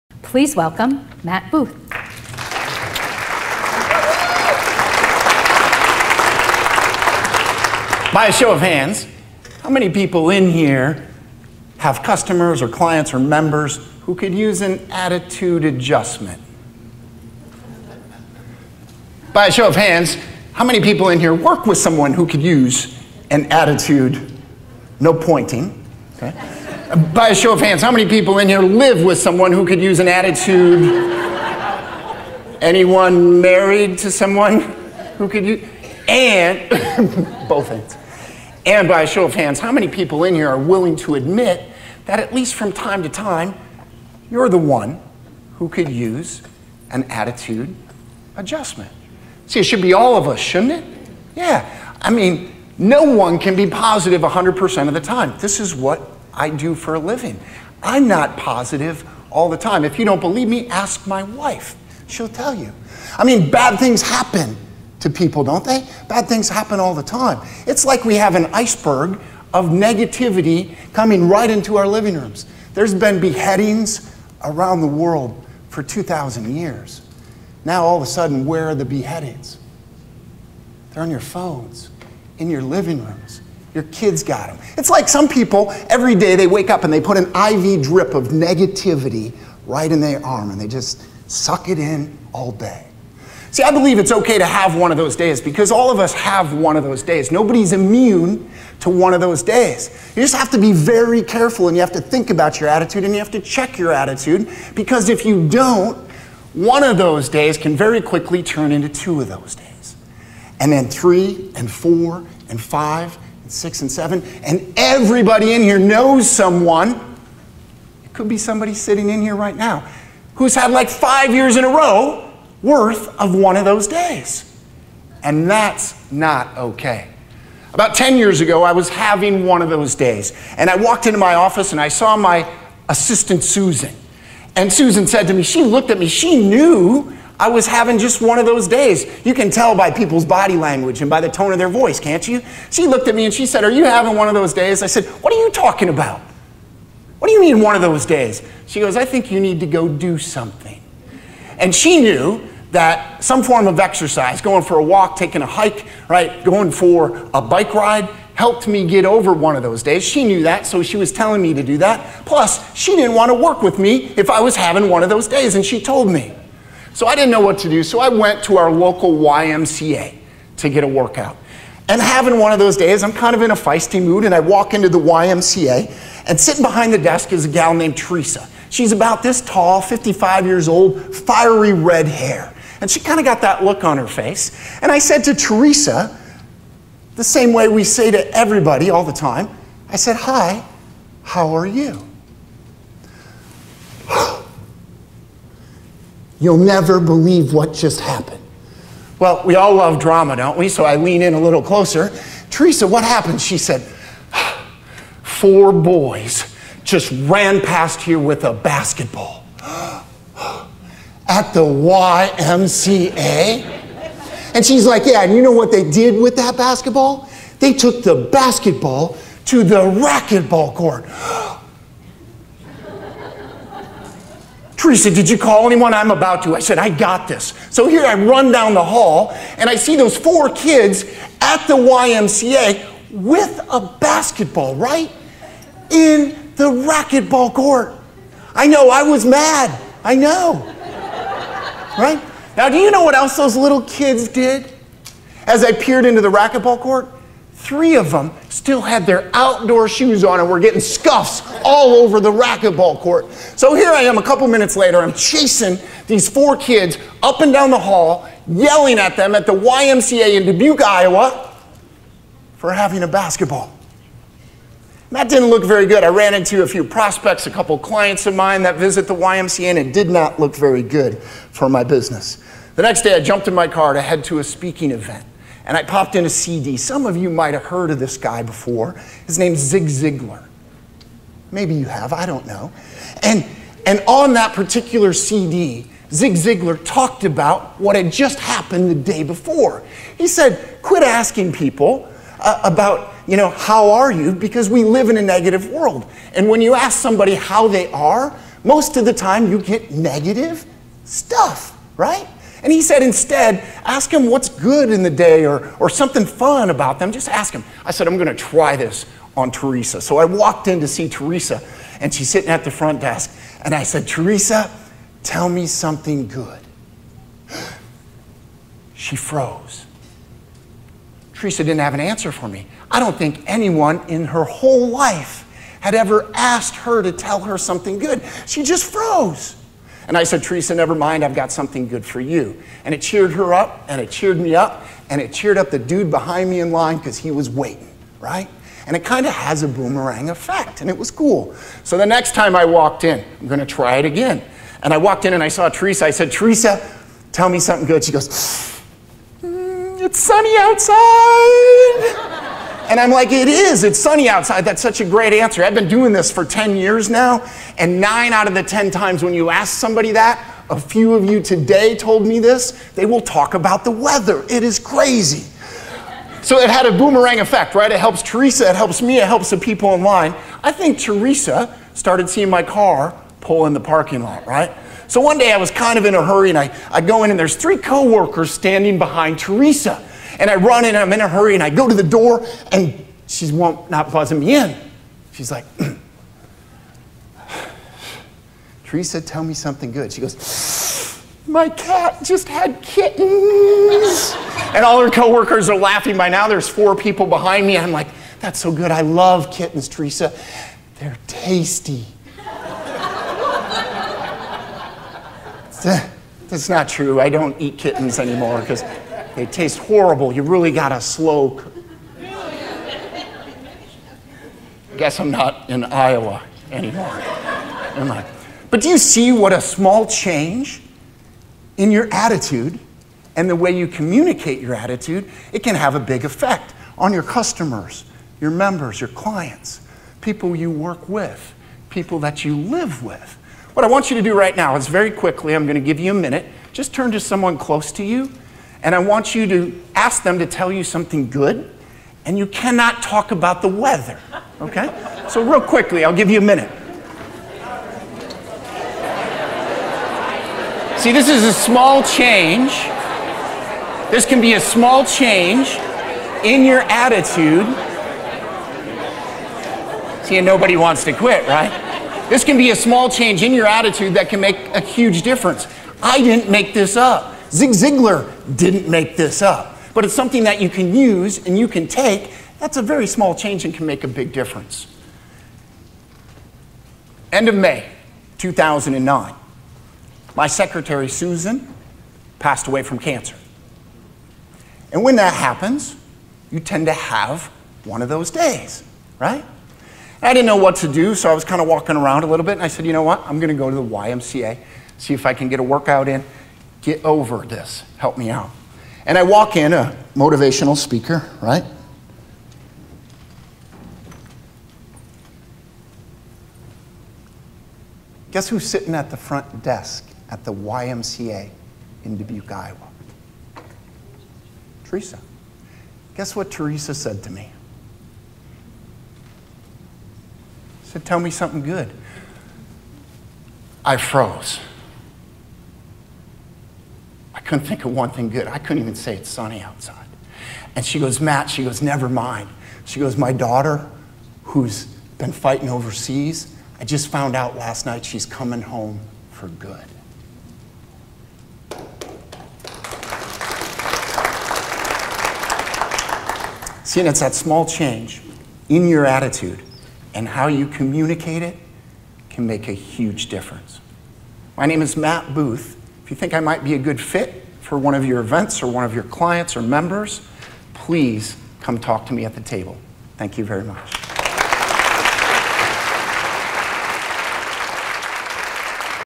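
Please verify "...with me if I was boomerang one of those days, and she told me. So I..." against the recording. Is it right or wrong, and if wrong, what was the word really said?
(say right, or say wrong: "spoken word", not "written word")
wrong: "having", not "boomerang".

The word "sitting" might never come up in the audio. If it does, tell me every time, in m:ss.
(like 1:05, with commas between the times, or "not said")
1:58, 2:56, 5:12, 8:28.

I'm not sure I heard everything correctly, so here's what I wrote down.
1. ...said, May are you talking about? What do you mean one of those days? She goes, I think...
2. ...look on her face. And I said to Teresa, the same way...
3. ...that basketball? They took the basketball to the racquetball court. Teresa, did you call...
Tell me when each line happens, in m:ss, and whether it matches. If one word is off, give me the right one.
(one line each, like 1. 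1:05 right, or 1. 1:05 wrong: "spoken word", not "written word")
1. 2:24 wrong: "What", not "May"
2. 3:03 right
3. 3:36 right.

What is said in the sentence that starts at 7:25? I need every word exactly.
So, real quickly, I'll give you a minute.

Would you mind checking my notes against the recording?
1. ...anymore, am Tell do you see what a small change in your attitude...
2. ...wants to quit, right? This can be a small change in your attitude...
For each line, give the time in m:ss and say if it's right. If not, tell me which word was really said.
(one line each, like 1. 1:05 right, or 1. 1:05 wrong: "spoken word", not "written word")
1. 6:56 wrong: "But", not "Tell"
2. 7:40 right.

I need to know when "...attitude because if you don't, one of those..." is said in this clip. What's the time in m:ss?
1:43.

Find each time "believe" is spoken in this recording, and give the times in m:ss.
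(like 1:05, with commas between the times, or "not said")
1:00, 1:33, 3:16.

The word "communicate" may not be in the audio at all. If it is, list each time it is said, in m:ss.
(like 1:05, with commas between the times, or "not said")
7:03, 9:10.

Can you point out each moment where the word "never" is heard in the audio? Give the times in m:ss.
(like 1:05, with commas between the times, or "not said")
3:16, 5:30, 8:51.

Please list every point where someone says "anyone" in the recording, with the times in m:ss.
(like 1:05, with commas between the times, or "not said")
0:32, 3:45, 5:23.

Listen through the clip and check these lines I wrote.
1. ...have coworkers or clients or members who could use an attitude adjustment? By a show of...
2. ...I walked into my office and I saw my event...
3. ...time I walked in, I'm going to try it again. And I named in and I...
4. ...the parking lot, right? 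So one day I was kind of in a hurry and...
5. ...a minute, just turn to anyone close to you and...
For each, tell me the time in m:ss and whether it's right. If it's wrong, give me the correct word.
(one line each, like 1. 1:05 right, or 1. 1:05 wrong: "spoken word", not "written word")
1. 0:11 wrong: "customers", not "coworkers"
2. 2:10 wrong: "assistant", not "event"
3. 5:42 wrong: "walked", not "named"
4. 6:13 right
5. 7:16 wrong: "someone", not "anyone".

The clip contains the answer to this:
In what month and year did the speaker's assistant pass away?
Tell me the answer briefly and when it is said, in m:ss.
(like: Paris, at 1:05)
May 2009, at 7:57.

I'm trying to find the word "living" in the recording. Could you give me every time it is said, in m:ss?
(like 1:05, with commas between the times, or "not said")
0:56, 1:11, 1:22.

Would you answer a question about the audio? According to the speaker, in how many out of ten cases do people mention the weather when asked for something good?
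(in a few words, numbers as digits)
9.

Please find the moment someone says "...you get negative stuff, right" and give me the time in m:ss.
4:59.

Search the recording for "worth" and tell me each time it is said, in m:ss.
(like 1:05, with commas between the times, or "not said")
2:02.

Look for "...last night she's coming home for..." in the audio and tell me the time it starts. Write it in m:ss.
8:57.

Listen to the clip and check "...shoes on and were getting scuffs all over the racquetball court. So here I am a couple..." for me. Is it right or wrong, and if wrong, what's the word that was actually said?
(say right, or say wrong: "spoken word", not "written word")
right.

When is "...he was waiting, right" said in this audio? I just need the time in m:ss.
5:37.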